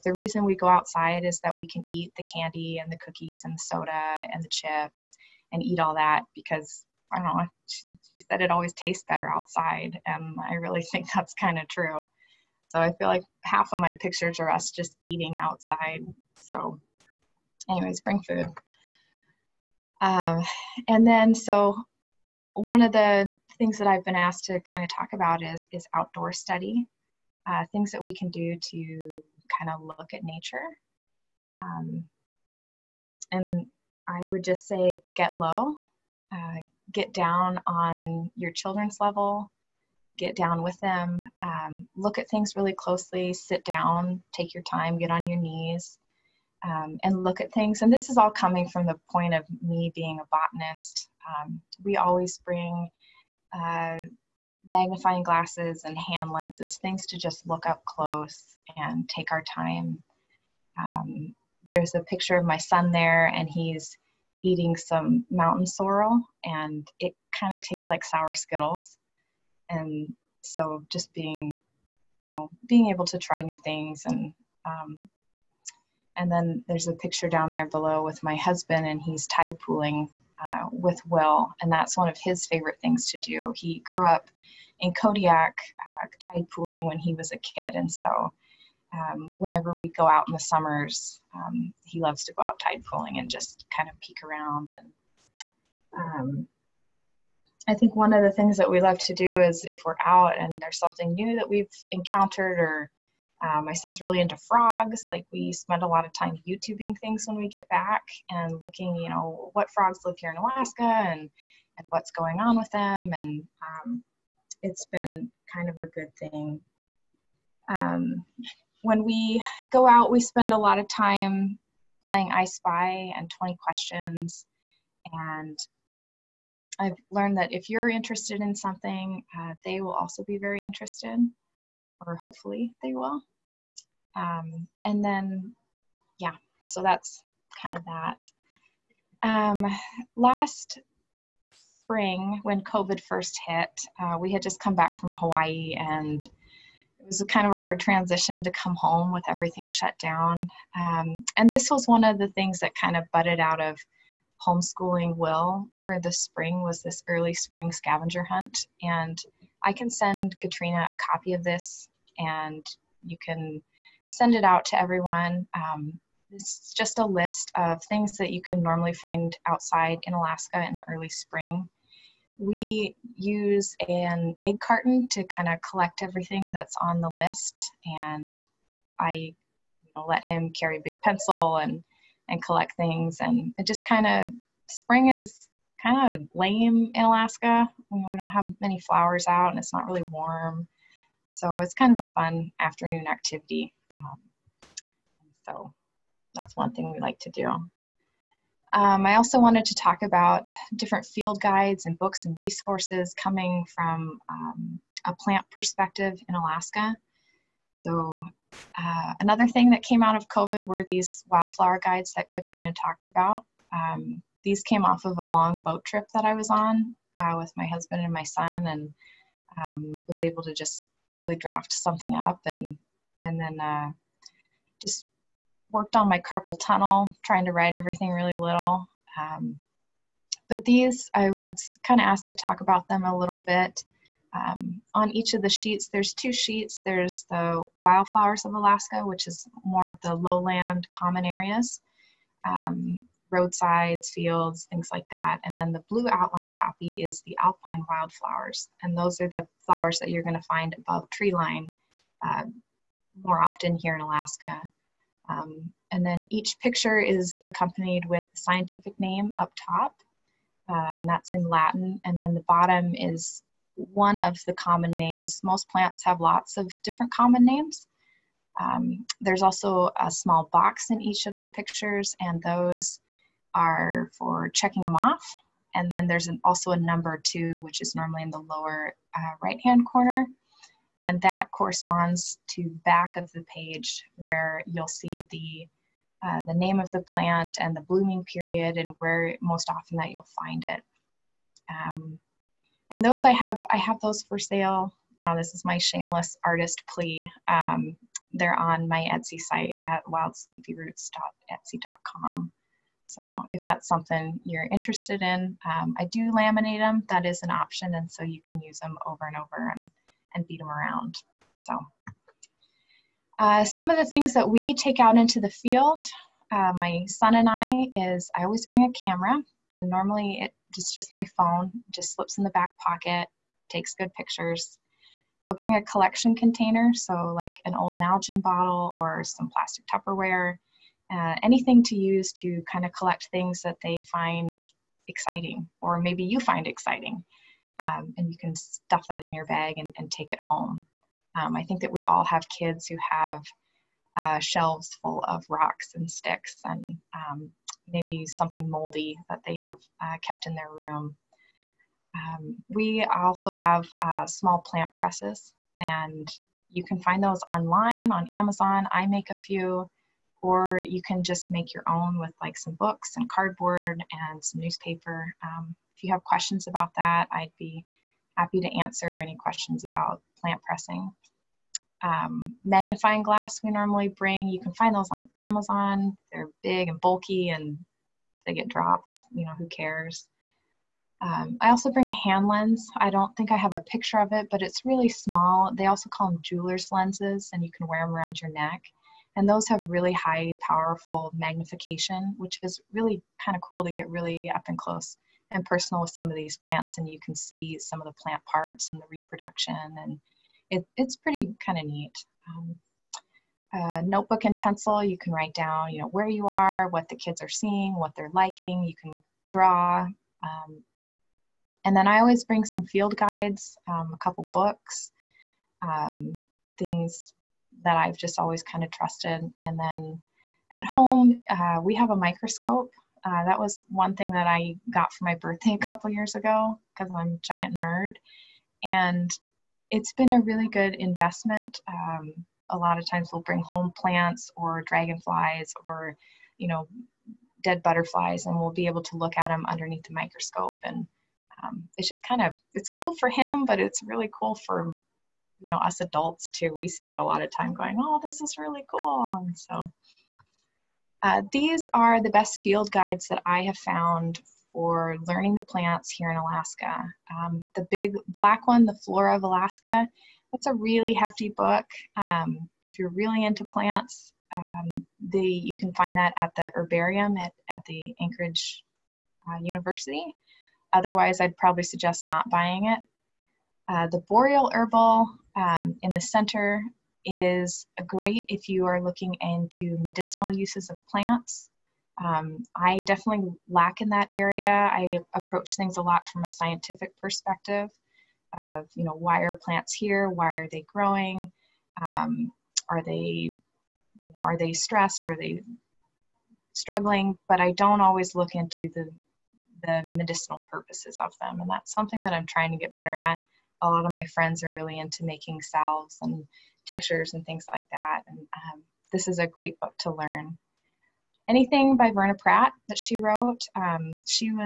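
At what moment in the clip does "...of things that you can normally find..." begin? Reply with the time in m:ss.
2:47.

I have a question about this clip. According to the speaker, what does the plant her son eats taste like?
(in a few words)
Sour Skittles.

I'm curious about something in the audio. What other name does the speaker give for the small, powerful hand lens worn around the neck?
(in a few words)
Jeweler's lenses.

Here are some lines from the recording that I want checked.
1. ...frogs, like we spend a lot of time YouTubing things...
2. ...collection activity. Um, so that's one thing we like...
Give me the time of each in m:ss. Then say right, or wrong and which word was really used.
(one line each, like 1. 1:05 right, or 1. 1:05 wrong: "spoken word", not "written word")
1. 1:44 right
2. 3:12 wrong: "afternoon", not "collection".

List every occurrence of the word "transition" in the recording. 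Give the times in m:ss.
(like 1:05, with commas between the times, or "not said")
2:27.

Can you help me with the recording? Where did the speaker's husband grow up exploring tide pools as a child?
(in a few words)
Kodiak.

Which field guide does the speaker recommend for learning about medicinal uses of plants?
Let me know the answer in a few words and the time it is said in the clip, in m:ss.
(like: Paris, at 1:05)
The Boreal Herbal, at 7:54.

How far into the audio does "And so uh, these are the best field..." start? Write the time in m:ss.
7:29.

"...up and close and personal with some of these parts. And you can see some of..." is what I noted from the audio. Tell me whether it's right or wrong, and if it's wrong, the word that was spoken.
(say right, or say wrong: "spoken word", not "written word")
wrong: "plants", not "parts".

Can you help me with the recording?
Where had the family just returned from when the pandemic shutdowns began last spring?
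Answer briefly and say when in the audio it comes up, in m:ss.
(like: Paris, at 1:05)
Hawaii, at 2:25.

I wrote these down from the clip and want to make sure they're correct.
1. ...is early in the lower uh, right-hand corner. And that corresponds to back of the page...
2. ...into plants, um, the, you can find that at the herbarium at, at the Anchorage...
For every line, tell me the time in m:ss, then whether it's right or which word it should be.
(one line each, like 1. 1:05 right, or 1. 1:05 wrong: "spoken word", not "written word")
1. 4:37 wrong: "normally", not "early"
2. 7:43 right.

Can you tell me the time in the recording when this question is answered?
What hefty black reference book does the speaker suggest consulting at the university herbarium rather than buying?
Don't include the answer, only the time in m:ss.
7:38.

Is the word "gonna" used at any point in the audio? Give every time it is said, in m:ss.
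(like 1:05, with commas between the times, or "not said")
4:10.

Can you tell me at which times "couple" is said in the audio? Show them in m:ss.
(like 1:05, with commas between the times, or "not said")
6:54, 7:05.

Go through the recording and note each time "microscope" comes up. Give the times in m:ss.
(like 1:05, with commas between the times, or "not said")
7:02, 7:20.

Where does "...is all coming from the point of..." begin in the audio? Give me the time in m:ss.
0:48.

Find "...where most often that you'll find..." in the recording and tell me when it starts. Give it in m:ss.
4:48.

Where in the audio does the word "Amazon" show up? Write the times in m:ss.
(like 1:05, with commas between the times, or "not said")
5:58, 6:15.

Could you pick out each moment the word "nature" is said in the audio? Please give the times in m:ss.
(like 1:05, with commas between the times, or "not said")
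0:30.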